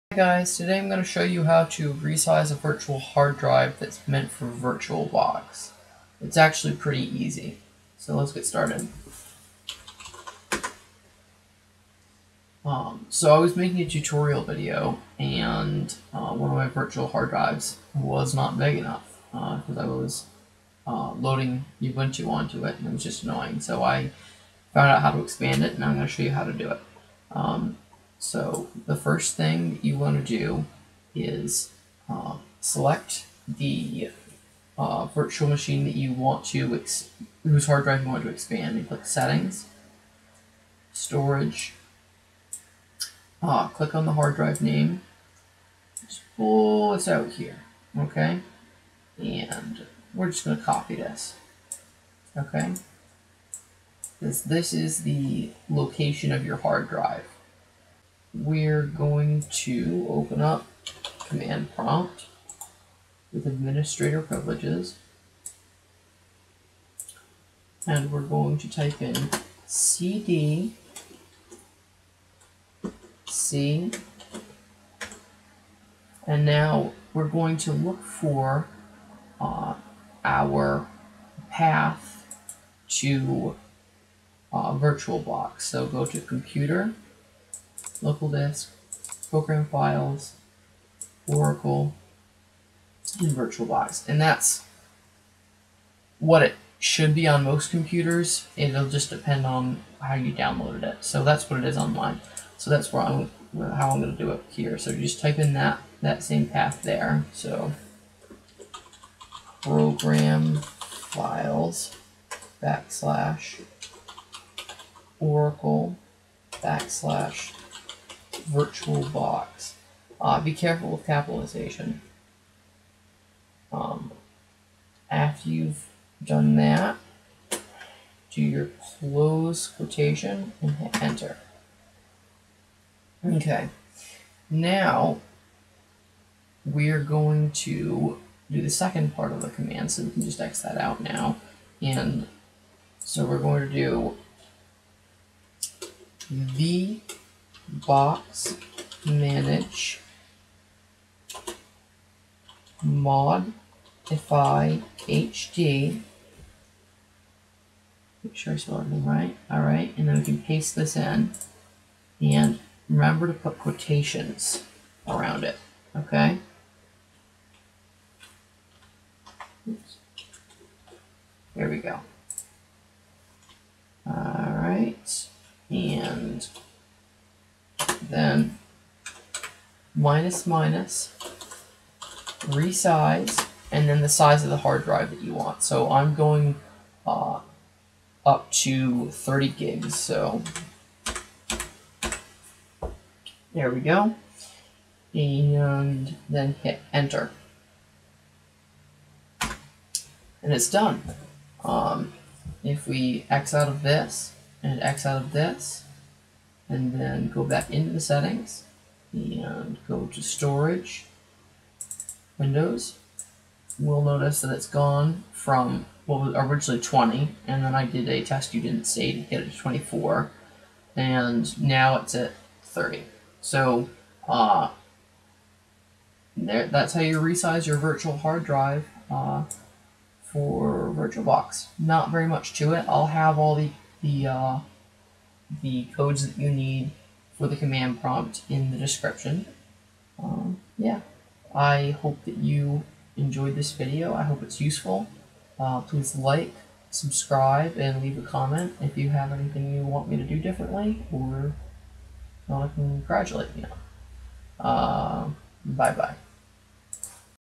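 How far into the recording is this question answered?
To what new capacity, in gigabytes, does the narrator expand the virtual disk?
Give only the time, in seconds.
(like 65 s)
189 s.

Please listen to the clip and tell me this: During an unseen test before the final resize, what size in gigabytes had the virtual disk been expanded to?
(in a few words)
24.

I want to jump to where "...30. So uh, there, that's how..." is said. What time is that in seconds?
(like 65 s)
222 s.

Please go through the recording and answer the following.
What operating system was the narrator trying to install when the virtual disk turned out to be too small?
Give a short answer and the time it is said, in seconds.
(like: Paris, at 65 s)
Ubuntu, at 21 s.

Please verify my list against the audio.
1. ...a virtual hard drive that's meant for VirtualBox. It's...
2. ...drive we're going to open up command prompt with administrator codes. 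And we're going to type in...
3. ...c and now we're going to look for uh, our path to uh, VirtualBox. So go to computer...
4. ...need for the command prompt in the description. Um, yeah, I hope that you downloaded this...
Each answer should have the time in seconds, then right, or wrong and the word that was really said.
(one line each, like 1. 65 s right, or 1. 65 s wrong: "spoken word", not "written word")
1. 2 s right
2. 56 s wrong: "privileges", not "codes"
3. 73 s right
4. 236 s wrong: "enjoyed", not "downloaded".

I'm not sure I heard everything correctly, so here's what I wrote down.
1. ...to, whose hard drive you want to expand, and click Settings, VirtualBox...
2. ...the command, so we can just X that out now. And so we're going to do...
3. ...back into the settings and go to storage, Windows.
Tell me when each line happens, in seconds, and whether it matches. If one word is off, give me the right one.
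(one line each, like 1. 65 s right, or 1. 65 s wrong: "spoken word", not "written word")
1. 36 s wrong: "Storage", not "VirtualBox"
2. 139 s right
3. 207 s right.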